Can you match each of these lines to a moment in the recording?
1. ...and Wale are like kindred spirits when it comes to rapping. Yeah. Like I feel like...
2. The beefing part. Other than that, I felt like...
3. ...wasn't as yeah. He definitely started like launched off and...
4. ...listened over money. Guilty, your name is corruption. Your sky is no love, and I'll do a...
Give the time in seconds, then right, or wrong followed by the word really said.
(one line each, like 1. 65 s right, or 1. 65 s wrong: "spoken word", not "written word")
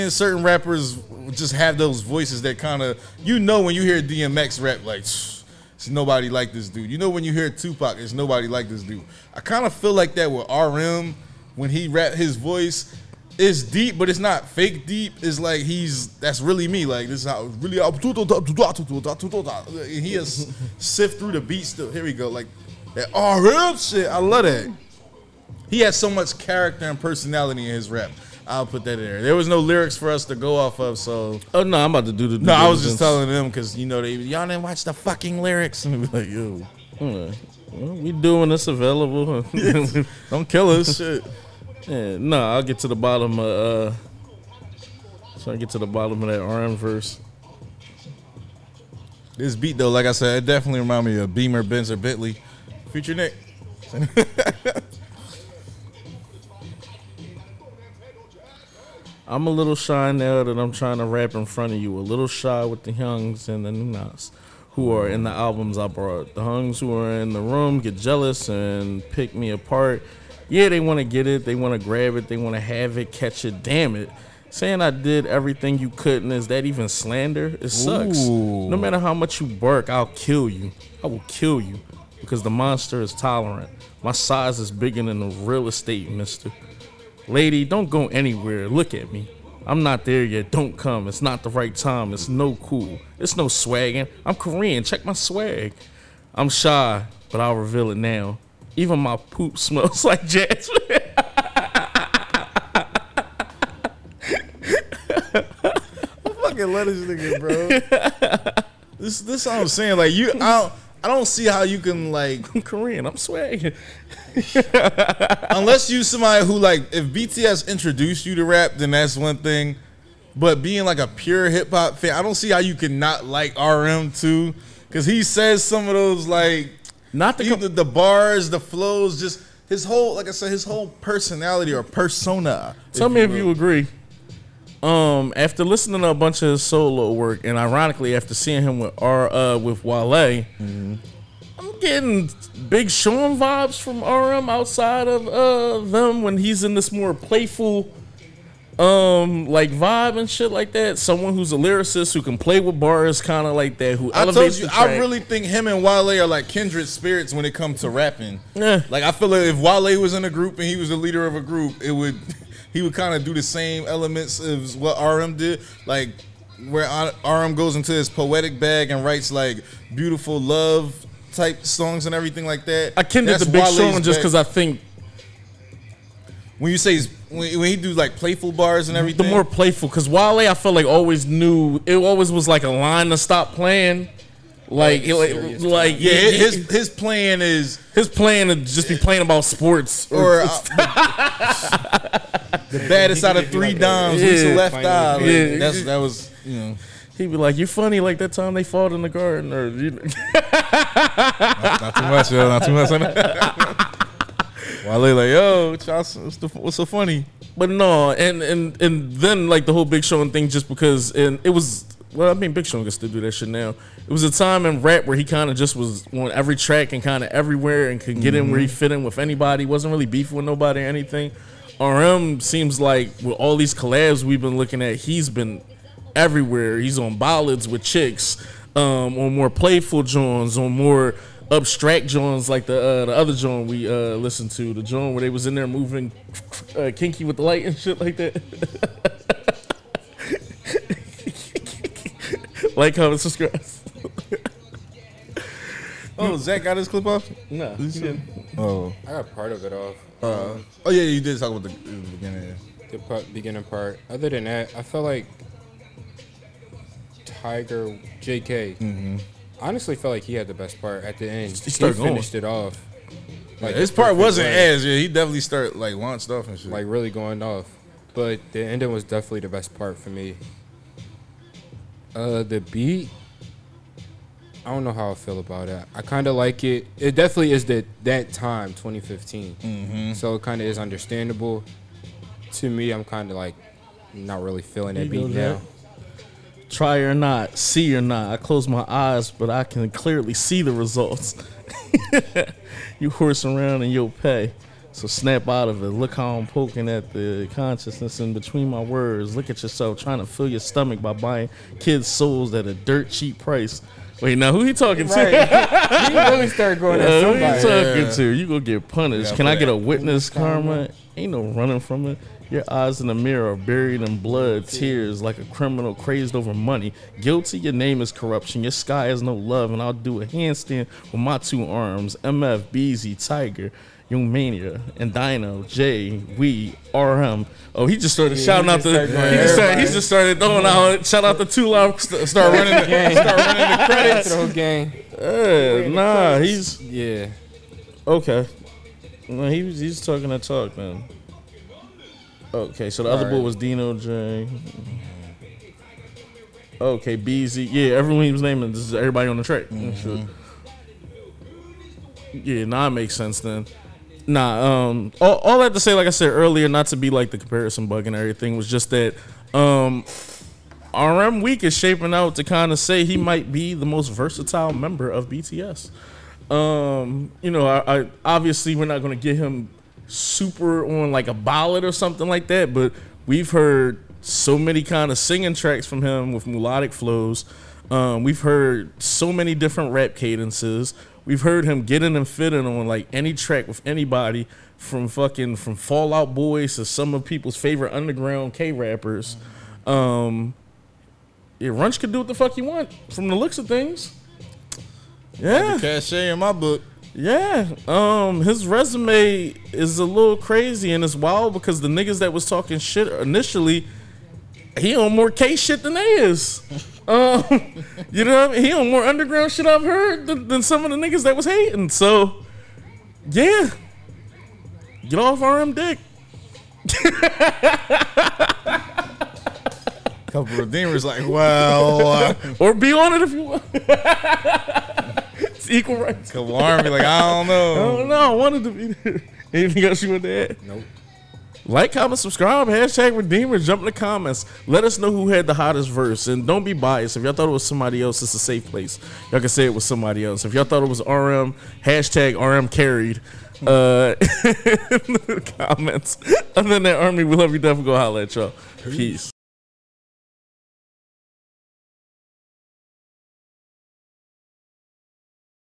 1. 155 s right
2. 252 s wrong: "beginning", not "beefing"
3. 264 s right
4. 315 s wrong: "crazed", not "listened".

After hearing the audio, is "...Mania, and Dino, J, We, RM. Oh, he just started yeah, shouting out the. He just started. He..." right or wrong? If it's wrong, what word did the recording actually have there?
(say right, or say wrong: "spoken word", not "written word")
right.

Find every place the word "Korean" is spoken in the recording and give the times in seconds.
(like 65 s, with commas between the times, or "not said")
94 s, 112 s.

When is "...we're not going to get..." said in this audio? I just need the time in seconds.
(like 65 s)
368 s.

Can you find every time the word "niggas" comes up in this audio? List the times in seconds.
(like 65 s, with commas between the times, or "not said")
107 s, 401 s, 410 s.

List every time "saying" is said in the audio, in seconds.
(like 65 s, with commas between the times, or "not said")
74 s, 109 s.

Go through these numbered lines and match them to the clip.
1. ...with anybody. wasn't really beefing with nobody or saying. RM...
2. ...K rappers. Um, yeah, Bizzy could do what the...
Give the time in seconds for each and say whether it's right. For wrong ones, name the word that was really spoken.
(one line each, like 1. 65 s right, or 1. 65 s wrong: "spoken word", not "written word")
1. 219 s wrong: "anything", not "saying"
2. 388 s wrong: "Runch", not "Bizzy".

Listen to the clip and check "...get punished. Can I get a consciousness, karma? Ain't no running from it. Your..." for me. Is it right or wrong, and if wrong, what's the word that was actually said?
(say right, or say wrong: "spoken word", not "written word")
wrong: "witness", not "consciousness".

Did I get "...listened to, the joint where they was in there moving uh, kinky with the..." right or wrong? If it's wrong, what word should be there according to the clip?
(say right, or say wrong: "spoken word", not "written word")
right.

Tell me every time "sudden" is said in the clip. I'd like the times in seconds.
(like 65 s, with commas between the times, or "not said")
not said.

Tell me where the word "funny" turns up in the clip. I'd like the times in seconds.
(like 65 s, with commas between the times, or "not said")
197 s, 206 s.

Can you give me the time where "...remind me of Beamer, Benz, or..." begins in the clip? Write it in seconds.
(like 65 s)
50 s.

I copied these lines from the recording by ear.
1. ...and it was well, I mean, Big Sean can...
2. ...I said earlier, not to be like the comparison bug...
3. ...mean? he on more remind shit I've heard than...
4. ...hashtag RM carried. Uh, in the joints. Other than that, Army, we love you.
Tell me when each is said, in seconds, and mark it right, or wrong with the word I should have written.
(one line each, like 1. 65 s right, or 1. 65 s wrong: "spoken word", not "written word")
1. 211 s right
2. 356 s right
3. 408 s wrong: "underground", not "remind"
4. 441 s wrong: "comments", not "joints".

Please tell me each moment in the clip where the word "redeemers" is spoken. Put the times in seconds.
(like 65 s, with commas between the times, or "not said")
420 s, 433 s.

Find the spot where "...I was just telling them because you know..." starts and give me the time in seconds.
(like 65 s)
32 s.